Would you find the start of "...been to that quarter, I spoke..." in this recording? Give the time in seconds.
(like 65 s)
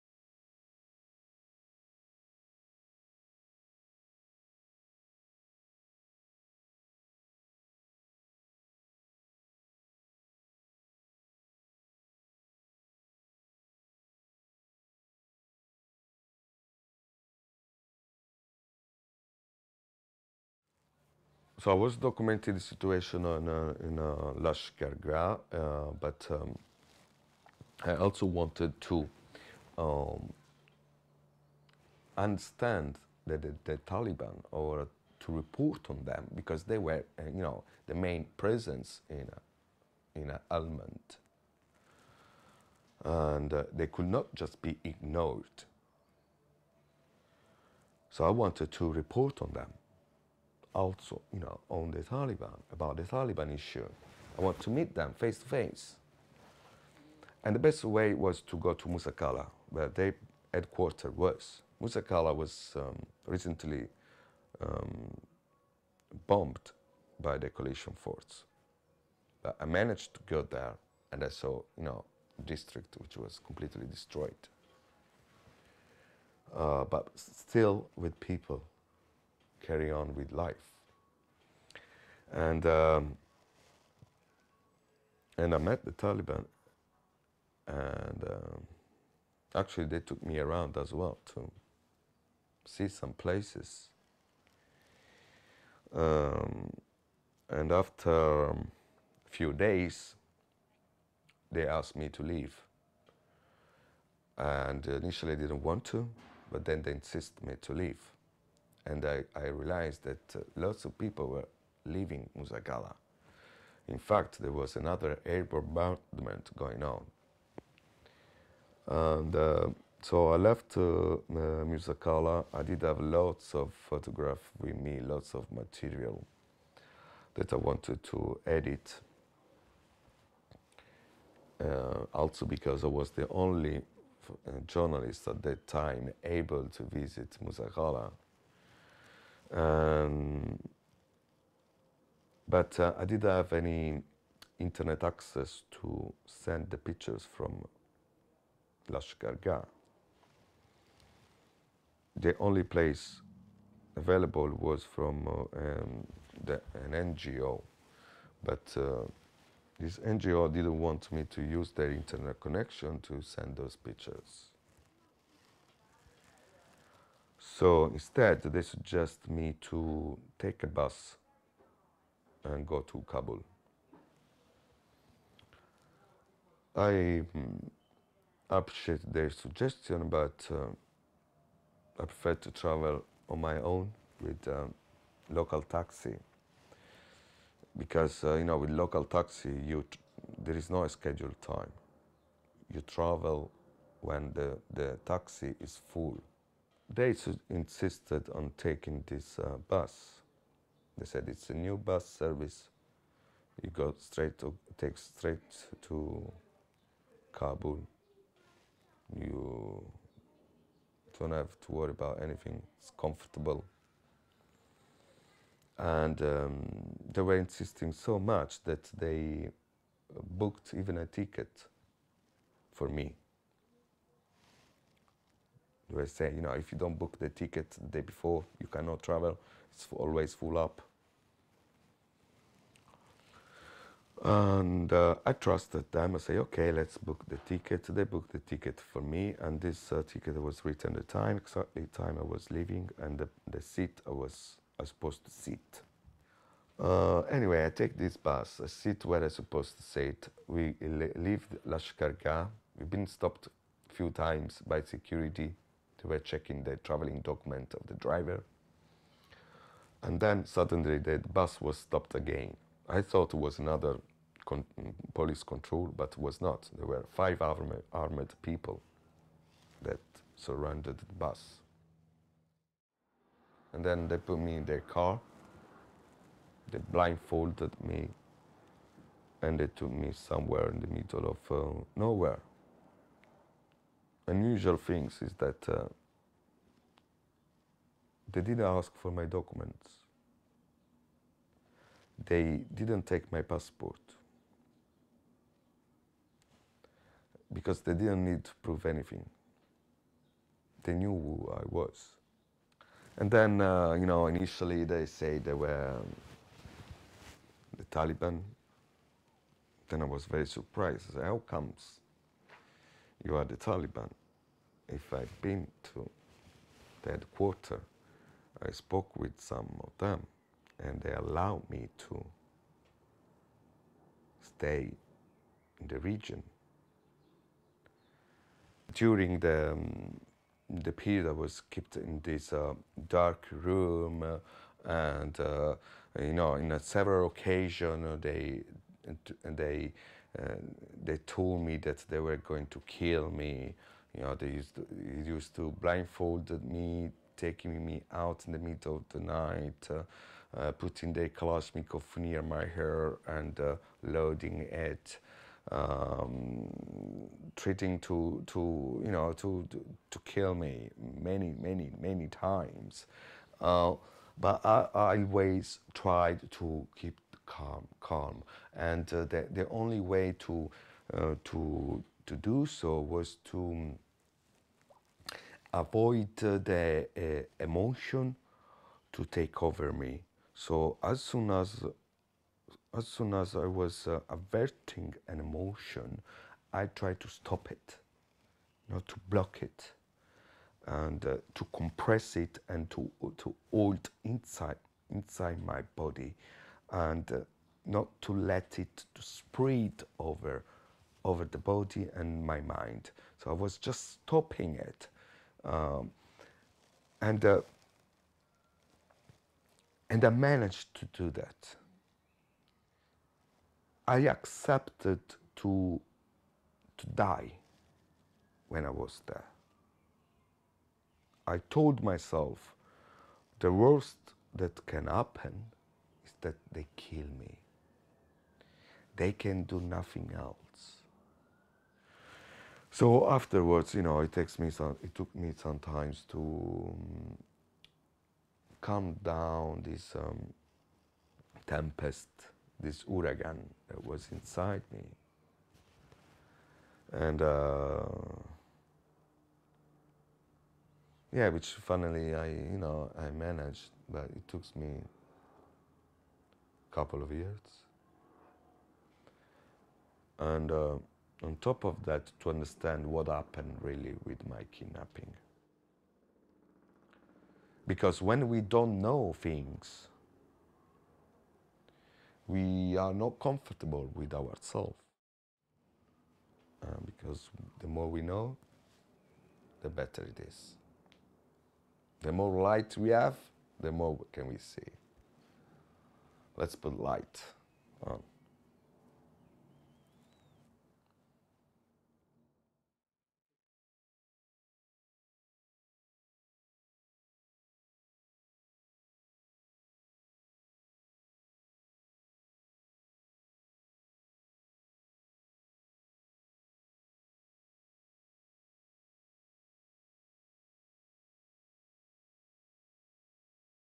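315 s.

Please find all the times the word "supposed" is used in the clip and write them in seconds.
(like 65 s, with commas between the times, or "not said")
244 s, 249 s.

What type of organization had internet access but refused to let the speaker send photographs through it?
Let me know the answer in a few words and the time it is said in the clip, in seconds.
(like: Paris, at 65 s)
An NGO, at 156 s.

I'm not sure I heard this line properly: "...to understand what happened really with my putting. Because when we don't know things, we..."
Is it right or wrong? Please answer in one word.
wrong.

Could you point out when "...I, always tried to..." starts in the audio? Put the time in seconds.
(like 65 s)
364 s.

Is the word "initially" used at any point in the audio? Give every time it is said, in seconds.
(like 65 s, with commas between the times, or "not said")
104 s, 304 s.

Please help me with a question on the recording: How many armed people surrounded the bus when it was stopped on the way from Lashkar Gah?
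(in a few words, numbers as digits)
5.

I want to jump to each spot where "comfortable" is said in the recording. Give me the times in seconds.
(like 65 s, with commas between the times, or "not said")
212 s, 473 s.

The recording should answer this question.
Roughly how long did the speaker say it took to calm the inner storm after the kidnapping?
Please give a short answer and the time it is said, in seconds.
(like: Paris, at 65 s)
A couple of years, at 456 s.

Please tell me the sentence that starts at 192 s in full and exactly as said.
You travel when the, the taxi is full they insisted on taking this uh, bus.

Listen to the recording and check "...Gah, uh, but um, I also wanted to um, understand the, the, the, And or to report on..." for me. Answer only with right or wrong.
wrong.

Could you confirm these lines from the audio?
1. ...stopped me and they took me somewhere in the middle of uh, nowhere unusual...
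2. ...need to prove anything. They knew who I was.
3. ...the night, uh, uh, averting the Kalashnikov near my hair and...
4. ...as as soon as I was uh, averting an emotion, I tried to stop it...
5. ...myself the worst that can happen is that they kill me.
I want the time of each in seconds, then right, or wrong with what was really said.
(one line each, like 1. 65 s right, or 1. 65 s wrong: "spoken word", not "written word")
1. 276 s wrong: "blindfolded", not "stopped"
2. 298 s right
3. 349 s wrong: "putting", not "averting"
4. 381 s right
5. 422 s right.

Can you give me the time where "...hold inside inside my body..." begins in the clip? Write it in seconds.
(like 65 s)
393 s.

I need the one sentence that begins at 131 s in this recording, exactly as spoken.
Uh, also because I was the only uh, journalist at that time able to visit Musa Qala.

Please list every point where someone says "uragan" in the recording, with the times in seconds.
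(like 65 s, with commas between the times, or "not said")
443 s.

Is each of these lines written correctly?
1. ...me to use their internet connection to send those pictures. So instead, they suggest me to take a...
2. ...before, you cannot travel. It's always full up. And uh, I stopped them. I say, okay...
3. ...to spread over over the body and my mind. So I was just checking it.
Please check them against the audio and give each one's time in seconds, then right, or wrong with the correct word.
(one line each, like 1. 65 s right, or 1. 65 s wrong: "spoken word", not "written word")
1. 161 s right
2. 228 s wrong: "trusted", not "stopped"
3. 399 s wrong: "stopping", not "checking".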